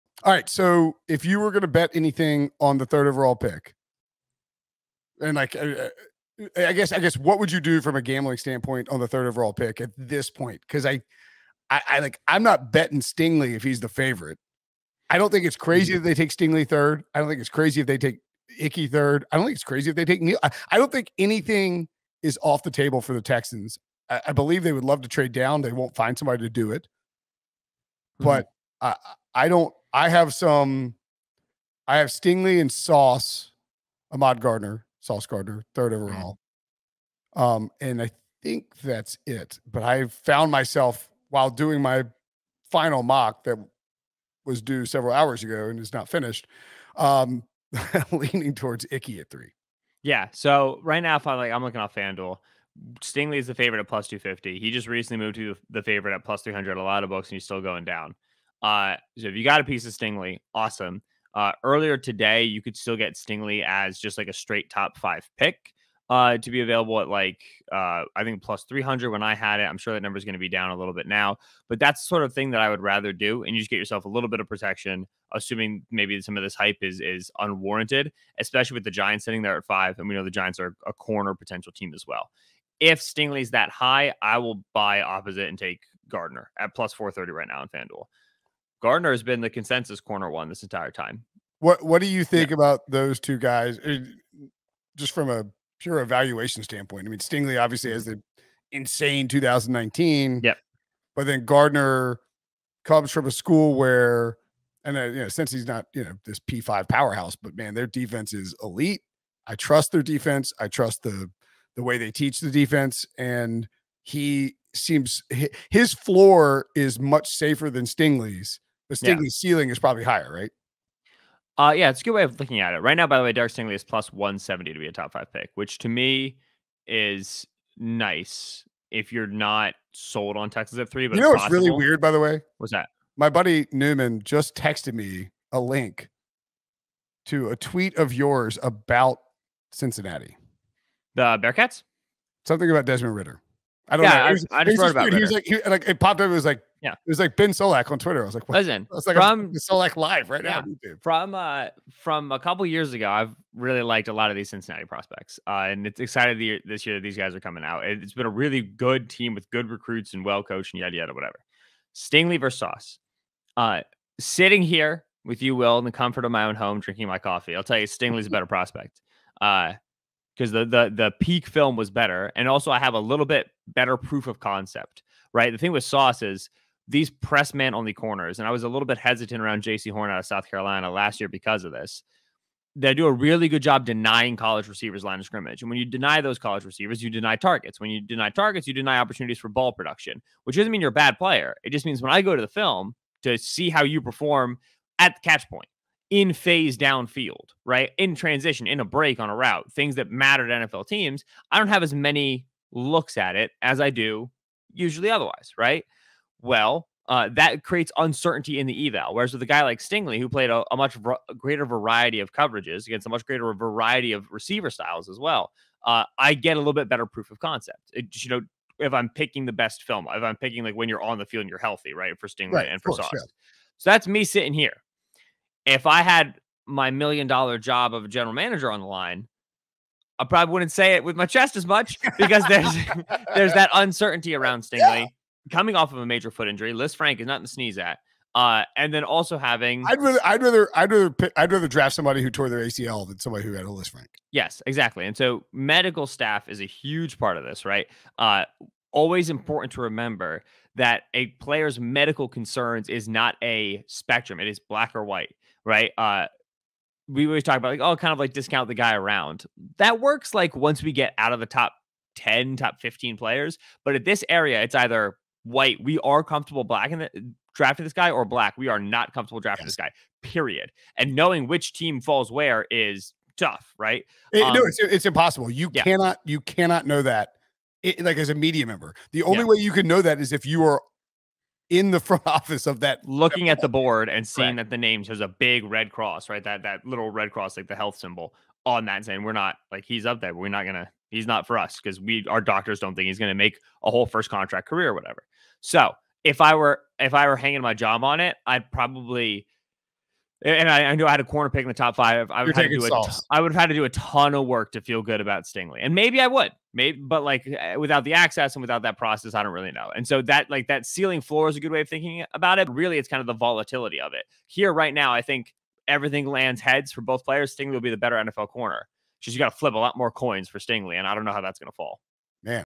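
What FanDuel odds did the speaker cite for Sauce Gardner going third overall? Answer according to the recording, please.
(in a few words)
+430.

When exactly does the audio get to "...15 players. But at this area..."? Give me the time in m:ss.
4:22.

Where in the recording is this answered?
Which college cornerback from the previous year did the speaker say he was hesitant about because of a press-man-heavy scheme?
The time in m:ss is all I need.
2:59.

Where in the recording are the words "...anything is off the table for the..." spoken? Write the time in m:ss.
0:21.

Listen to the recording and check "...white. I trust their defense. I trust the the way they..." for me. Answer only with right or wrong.
wrong.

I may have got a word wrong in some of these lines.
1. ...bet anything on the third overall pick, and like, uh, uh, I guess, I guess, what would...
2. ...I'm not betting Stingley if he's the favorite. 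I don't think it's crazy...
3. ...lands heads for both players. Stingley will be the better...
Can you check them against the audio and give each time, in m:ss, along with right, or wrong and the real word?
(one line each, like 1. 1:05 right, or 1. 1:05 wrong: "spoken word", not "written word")
1. 0:01 right
2. 0:12 right
3. 5:16 right.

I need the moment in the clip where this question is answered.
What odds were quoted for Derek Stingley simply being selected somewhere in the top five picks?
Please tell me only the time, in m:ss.
2:03.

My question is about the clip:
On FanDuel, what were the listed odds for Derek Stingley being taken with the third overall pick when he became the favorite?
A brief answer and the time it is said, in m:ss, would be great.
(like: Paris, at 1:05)
+250, at 0:53.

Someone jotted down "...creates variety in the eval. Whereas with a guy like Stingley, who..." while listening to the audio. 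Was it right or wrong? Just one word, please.
wrong.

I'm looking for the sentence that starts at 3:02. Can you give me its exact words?
They do a really good job denying college receivers line of scrimmage.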